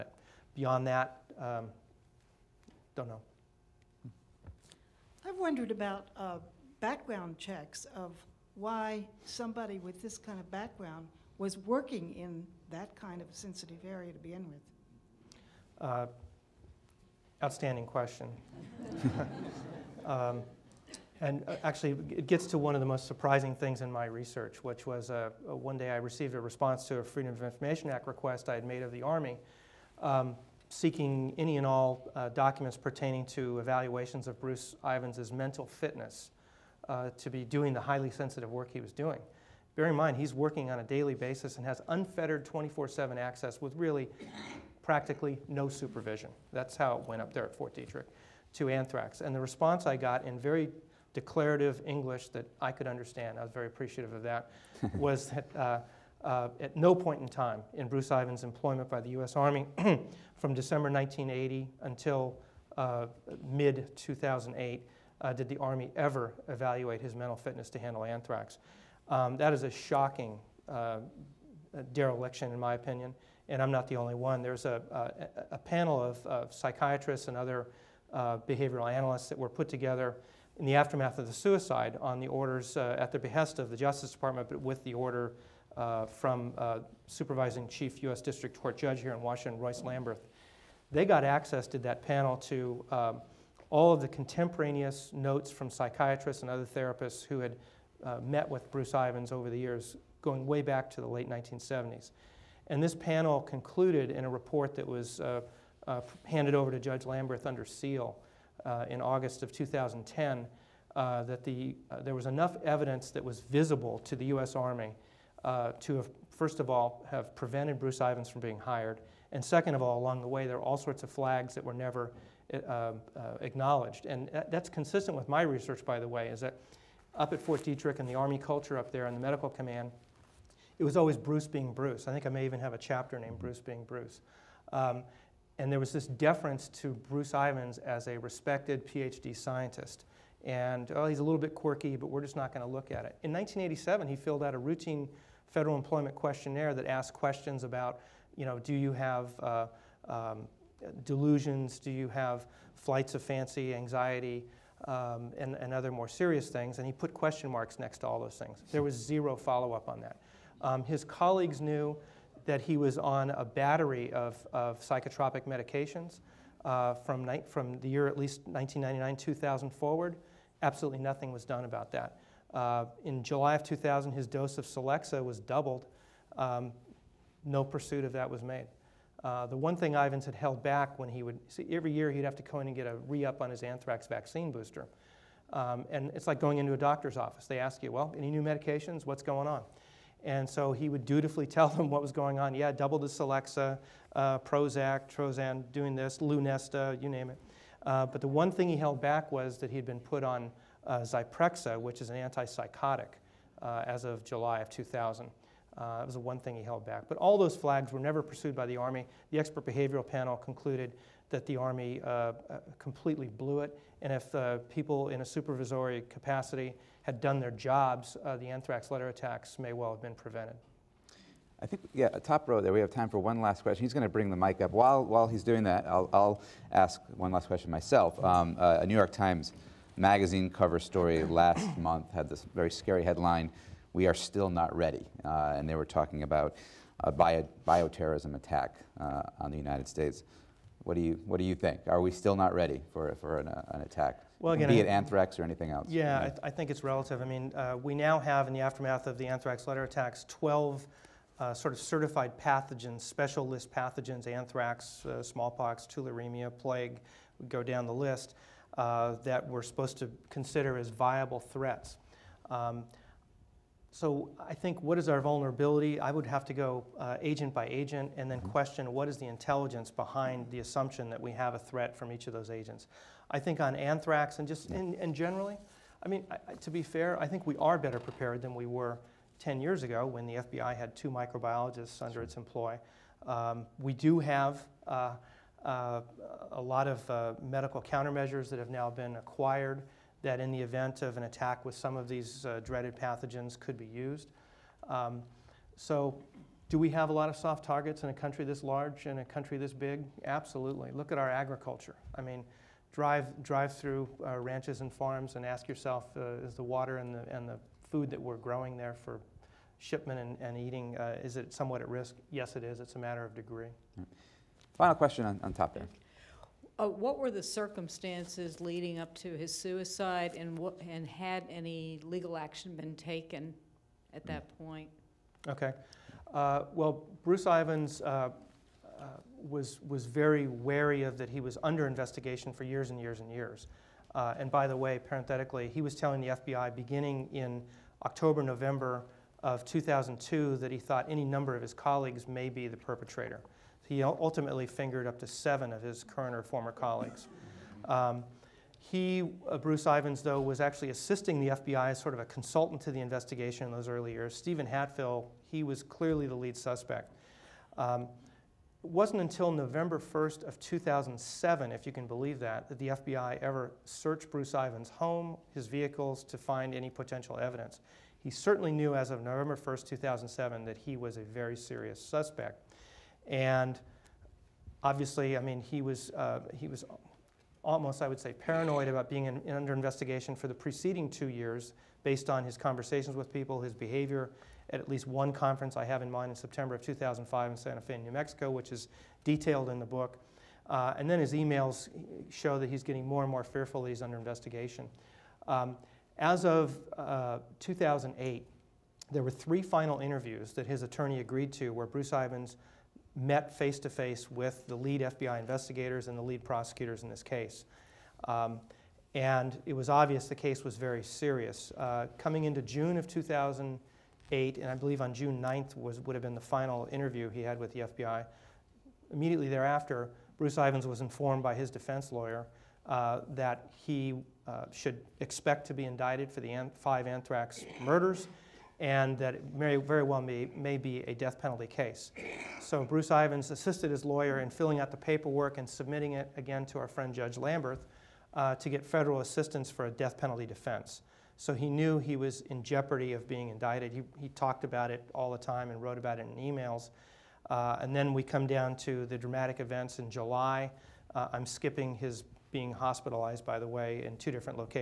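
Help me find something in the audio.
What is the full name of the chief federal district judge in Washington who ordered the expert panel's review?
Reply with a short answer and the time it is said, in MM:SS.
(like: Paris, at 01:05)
Royce Lamberth, at 01:29.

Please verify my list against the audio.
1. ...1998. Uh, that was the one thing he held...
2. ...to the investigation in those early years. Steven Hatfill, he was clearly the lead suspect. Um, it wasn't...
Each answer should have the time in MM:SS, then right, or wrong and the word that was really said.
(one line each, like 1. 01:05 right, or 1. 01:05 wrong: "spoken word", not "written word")
1. 03:24 wrong: "2000", not "1998"
2. 05:52 right.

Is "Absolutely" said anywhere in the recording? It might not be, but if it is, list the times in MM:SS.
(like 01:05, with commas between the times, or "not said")
02:50, 05:00.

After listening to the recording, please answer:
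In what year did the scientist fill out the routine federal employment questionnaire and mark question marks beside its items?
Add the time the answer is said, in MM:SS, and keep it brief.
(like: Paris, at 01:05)
1987, at 02:23.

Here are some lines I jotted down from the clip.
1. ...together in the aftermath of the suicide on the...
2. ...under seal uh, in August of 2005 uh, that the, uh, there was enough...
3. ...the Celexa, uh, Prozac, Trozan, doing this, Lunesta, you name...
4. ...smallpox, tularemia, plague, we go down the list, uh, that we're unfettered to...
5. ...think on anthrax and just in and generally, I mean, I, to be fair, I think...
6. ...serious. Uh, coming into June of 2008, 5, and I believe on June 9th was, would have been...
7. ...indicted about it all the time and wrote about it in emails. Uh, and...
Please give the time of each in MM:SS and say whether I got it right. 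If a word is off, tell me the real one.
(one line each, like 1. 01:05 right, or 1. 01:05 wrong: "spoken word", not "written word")
1. 01:19 right
2. 01:47 wrong: "2010", not "2005"
3. 03:12 right
4. 04:15 wrong: "supposed", not "unfettered"
5. 04:33 right
6. 06:51 wrong: "8", not "5"
7. 07:24 wrong: "talked", not "indicted".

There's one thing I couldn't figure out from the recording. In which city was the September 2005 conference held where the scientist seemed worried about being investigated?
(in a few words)
Santa Fe.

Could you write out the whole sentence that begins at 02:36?
And he put question marks next to all those things.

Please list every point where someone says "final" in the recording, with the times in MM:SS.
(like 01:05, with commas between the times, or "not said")
05:14, 06:39, 06:56.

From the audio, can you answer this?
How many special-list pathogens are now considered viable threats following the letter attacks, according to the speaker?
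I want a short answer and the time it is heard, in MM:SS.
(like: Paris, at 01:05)
12, at 04:10.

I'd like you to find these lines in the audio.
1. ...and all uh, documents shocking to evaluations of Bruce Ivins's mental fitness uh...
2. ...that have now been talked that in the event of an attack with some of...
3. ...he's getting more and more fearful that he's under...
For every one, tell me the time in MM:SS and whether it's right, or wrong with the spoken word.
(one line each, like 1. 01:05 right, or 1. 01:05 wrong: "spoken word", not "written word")
1. 00:31 wrong: "pertaining", not "shocking"
2. 04:48 wrong: "acquired", not "talked"
3. 06:32 right.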